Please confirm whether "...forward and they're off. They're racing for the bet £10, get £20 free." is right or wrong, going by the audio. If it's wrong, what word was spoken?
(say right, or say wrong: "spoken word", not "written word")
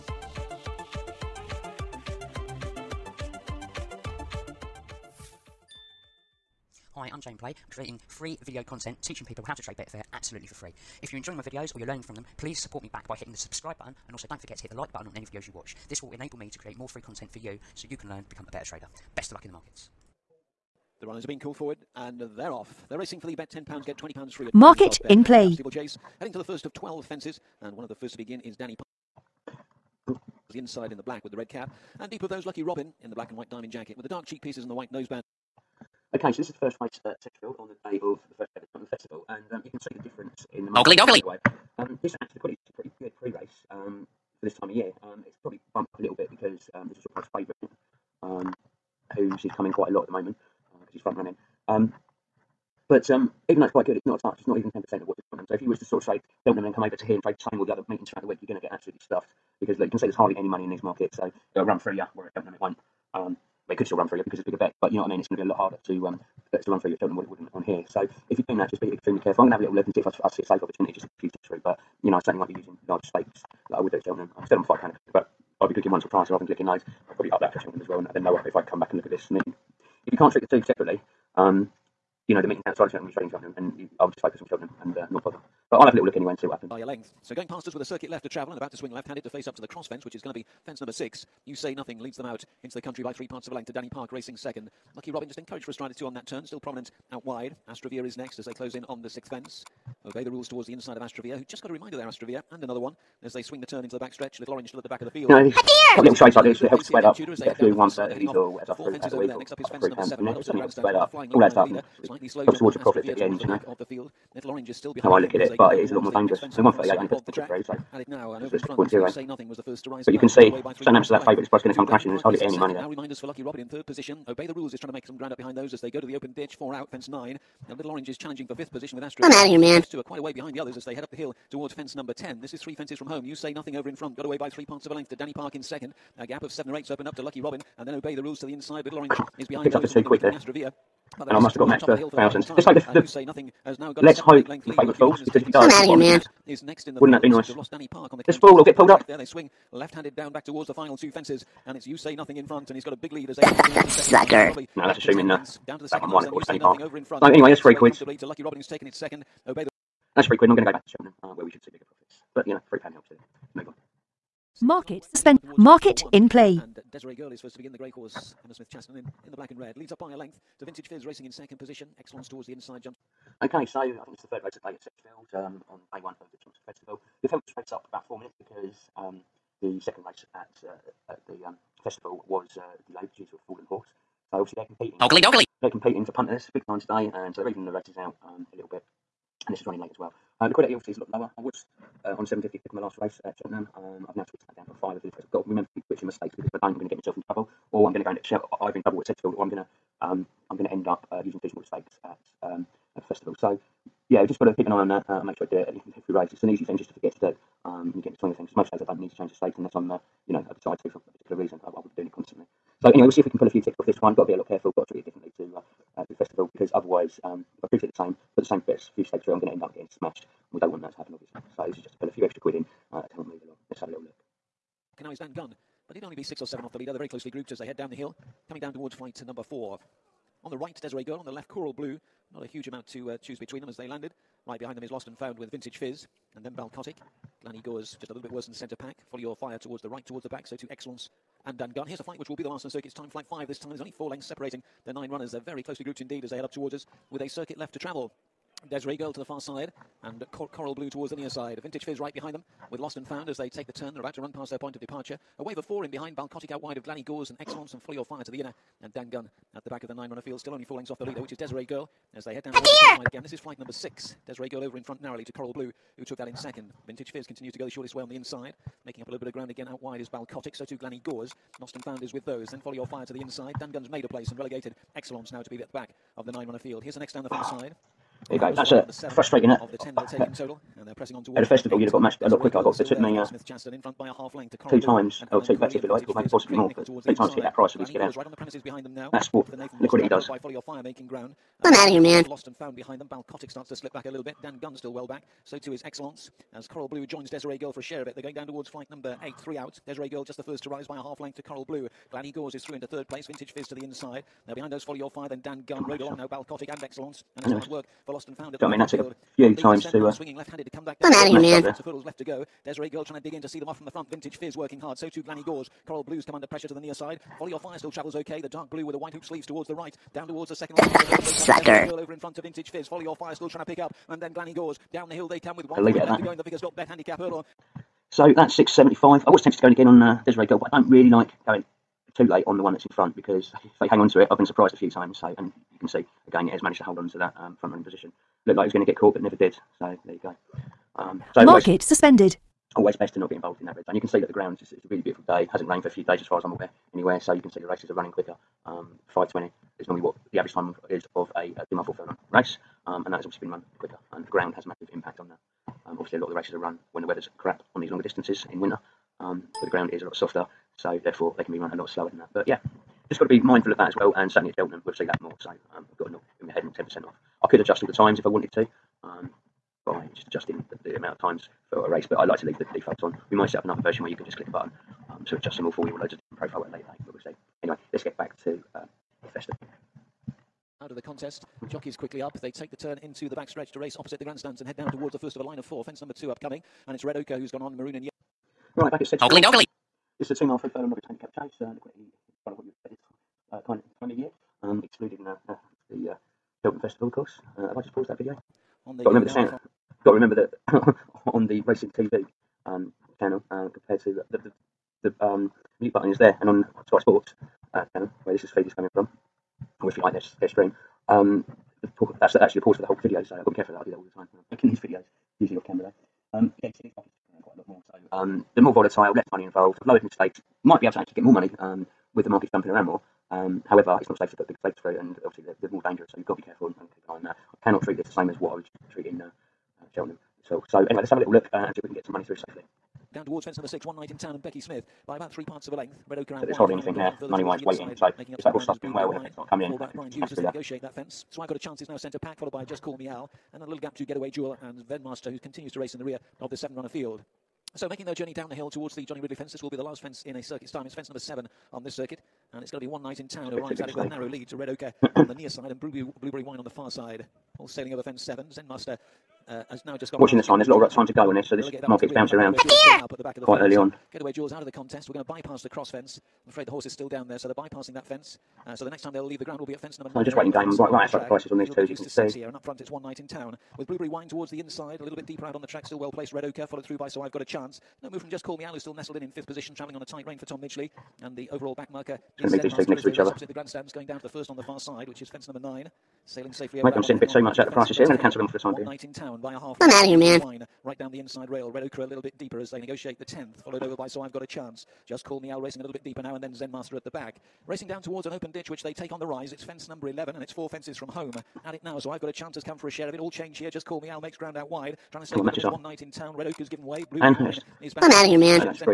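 right.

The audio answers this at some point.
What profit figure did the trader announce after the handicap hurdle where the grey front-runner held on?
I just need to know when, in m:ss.
5:28.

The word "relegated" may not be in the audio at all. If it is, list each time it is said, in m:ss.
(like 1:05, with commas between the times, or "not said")
4:34.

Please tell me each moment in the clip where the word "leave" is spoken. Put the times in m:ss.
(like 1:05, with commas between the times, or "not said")
6:12, 7:49.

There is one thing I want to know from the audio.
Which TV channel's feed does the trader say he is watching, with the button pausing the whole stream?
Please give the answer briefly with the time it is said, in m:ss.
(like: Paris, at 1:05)
Sky Sports, at 6:46.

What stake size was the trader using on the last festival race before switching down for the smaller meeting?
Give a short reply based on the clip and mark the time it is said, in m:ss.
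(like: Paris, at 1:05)
750, at 3:12.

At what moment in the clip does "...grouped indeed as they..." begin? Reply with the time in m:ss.
4:05.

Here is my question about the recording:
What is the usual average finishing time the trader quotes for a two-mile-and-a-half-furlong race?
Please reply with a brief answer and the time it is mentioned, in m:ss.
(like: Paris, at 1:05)
5:20, at 5:49.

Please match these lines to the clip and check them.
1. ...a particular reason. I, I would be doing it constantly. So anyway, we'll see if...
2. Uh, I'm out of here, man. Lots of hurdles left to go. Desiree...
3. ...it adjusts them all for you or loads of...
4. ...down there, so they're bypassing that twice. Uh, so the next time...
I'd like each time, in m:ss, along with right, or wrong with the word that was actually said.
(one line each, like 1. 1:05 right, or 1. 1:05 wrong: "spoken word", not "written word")
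1. 3:30 right
2. 5:10 right
3. 6:15 right
4. 7:47 wrong: "fence", not "twice".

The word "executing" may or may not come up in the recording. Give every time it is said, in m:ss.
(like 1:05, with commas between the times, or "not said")
not said.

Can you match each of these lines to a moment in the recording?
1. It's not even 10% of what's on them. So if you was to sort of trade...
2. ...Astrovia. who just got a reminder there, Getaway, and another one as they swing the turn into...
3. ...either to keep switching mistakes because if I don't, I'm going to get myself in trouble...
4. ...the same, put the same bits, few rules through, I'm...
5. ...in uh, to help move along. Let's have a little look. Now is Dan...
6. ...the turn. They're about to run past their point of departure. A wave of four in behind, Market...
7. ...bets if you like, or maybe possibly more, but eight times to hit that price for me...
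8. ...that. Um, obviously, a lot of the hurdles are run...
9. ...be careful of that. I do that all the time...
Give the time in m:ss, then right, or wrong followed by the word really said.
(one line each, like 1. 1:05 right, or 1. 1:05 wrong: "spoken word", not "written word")
1. 0:54 right
2. 1:41 wrong: "Astrovia", not "Getaway"
3. 3:15 wrong: "remember", not "either"
4. 3:37 wrong: "stakes", not "rules"
5. 3:42 right
6. 4:13 wrong: "Balcotic", not "Market"
7. 4:45 wrong: "two", not "eight"
8. 5:55 wrong: "races", not "hurdles"
9. 6:53 right.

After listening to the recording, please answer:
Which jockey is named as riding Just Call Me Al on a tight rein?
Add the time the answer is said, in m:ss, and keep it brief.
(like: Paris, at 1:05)
Tom Midgley, at 8:00.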